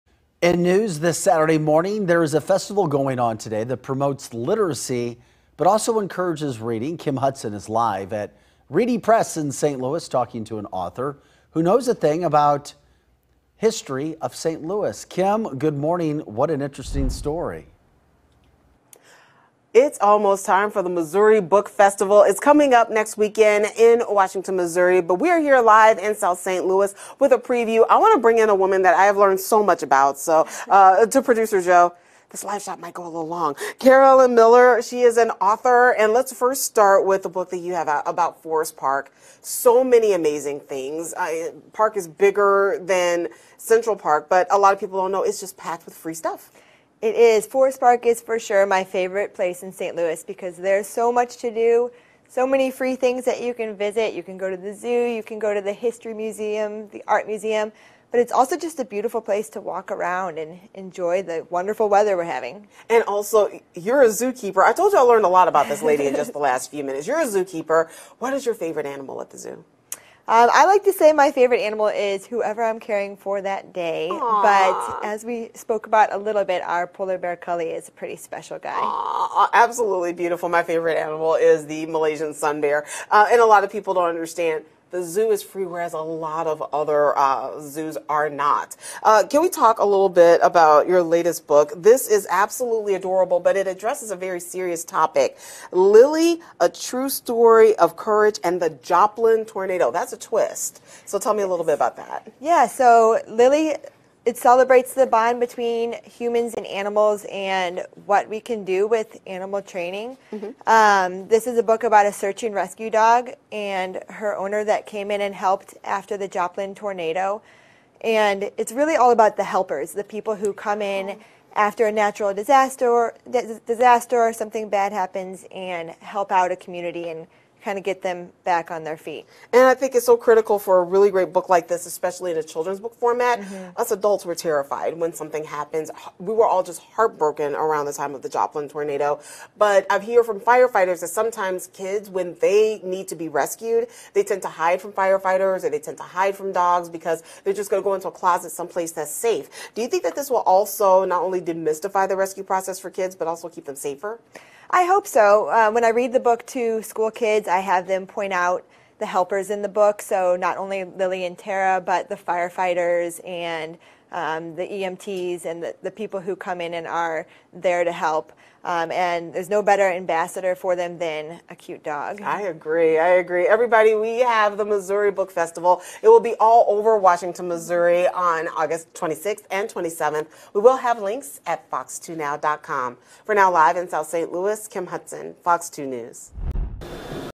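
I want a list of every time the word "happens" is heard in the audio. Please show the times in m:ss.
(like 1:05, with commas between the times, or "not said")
2:04, 2:15.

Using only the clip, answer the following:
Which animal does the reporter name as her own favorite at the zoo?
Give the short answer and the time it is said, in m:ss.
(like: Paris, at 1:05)
Malaysian sun bear, at 1:21.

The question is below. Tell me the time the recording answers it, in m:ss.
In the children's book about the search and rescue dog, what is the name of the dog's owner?
2:41.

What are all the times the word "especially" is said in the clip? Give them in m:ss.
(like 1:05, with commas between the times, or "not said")
2:11.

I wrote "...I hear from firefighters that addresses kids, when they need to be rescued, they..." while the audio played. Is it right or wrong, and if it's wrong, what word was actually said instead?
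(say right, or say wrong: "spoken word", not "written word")
wrong: "sometimes", not "addresses".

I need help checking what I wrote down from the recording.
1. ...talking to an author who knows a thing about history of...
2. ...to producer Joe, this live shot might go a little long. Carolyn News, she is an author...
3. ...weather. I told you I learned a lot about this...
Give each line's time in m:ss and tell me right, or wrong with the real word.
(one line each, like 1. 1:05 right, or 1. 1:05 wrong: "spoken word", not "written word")
1. 0:10 right
2. 0:31 wrong: "Mueller", not "News"
3. 1:04 wrong: "zookeeper", not "weather".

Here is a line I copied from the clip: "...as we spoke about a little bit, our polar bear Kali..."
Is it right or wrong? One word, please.
right.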